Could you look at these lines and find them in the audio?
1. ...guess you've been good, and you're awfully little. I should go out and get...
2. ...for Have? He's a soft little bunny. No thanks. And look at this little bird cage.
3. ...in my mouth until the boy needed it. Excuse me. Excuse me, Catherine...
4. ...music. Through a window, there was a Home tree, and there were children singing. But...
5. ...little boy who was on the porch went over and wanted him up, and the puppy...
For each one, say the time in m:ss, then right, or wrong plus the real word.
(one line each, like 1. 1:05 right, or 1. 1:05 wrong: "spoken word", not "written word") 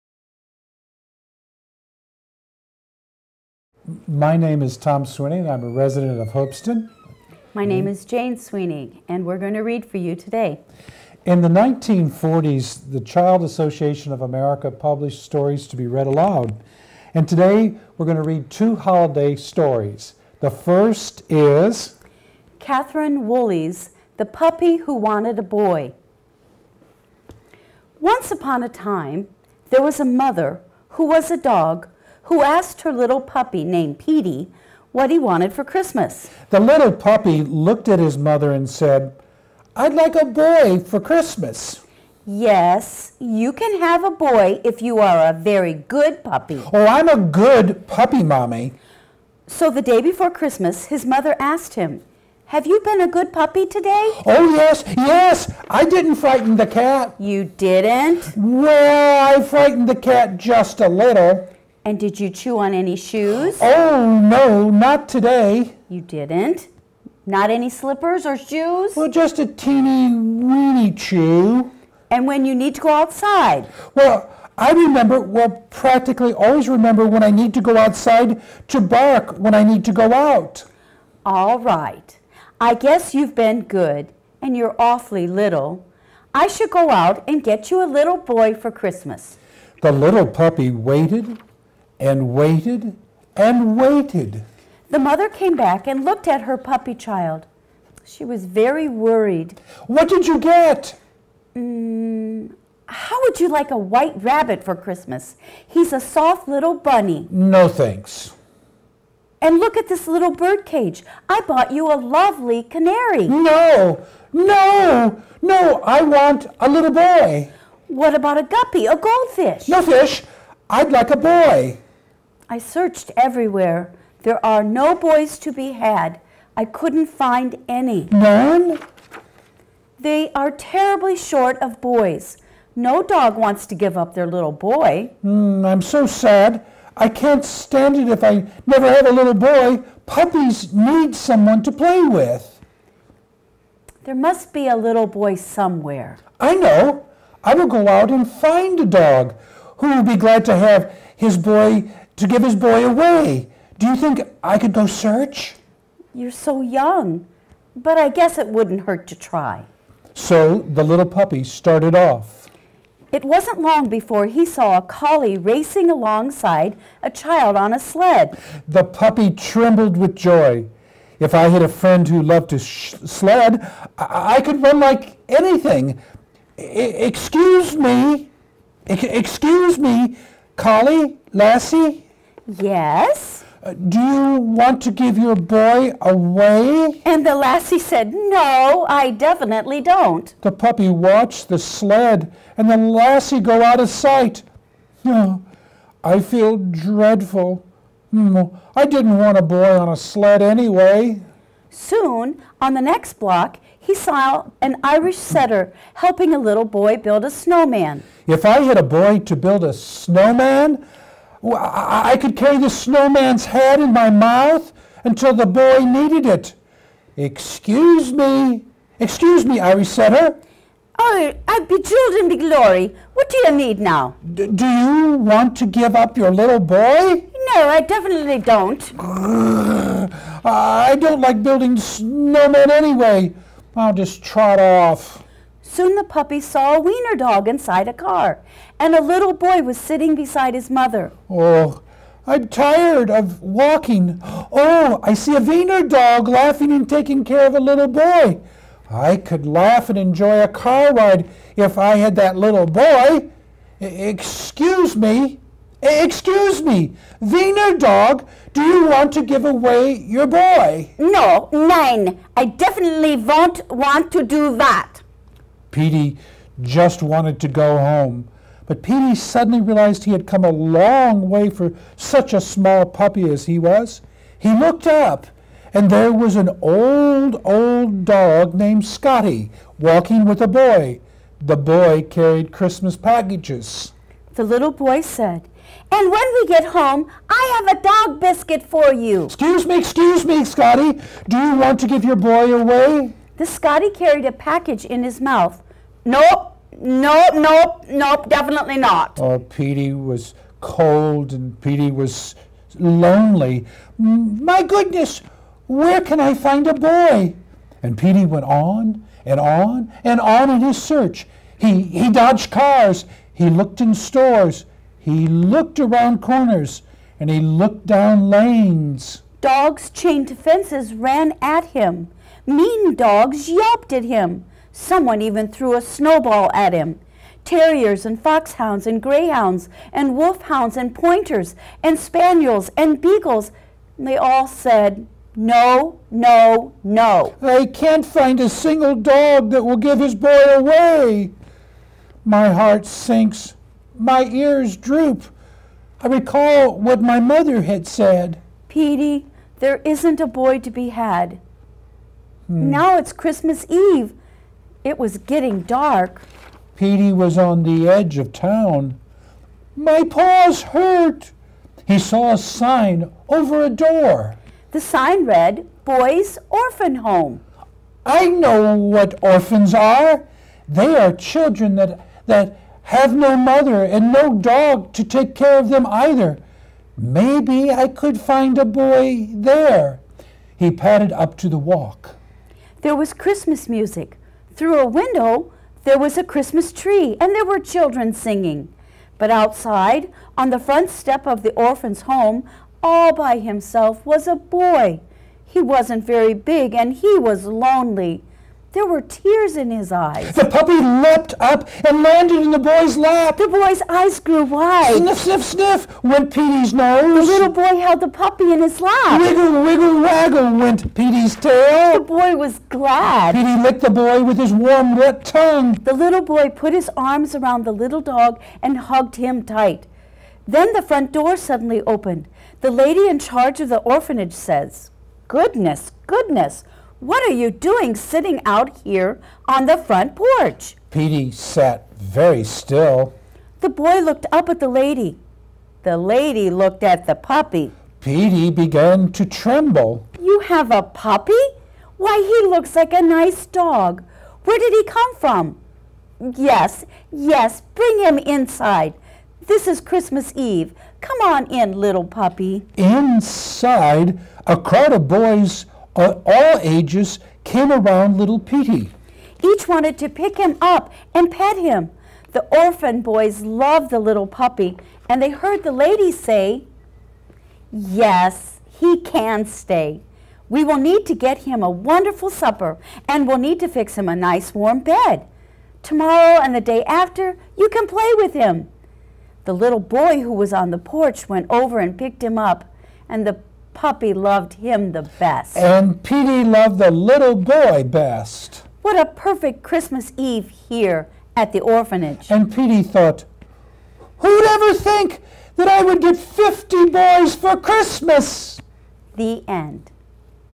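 1. 1:22 right
2. 1:44 wrong: "Christmas", not "Have"
3. 3:33 wrong: "Irish", not "Catherine"
4. 6:23 wrong: "Christmas", not "Home"
5. 7:59 wrong: "picked", not "wanted".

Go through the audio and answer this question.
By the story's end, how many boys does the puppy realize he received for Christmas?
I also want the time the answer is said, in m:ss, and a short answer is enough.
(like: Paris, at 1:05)
50, at 8:16.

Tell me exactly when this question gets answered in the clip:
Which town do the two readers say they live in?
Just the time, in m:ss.
0:06.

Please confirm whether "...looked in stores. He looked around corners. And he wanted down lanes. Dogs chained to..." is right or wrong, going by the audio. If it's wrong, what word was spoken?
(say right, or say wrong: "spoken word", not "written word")
wrong: "looked", not "wanted".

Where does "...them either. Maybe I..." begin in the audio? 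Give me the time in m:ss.
6:15.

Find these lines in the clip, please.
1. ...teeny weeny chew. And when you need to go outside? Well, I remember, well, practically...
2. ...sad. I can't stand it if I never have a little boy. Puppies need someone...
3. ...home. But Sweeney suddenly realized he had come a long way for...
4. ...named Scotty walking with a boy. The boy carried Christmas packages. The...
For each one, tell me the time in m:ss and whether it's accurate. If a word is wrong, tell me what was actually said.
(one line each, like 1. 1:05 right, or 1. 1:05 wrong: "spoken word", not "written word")
1. 1:09 right
2. 2:16 right
3. 4:27 wrong: "Petey", not "Sweeney"
4. 4:38 right.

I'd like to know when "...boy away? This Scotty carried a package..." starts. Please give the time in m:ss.
4:52.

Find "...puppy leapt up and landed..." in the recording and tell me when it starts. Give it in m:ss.
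6:40.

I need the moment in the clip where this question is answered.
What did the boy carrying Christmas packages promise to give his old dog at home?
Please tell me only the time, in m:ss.
4:47.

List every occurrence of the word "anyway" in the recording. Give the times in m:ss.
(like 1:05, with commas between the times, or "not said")
3:20, 3:52.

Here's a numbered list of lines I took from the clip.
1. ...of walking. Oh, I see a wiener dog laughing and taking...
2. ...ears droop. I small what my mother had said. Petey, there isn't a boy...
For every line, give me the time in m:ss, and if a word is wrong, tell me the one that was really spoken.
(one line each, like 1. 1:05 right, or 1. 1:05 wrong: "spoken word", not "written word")
1. 4:03 right
2. 5:44 wrong: "recall", not "small".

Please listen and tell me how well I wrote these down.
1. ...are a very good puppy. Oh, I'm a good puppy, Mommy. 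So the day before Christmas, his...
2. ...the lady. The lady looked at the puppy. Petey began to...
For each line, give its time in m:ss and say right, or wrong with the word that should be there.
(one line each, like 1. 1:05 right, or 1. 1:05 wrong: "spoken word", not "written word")
1. 0:44 right
2. 7:14 right.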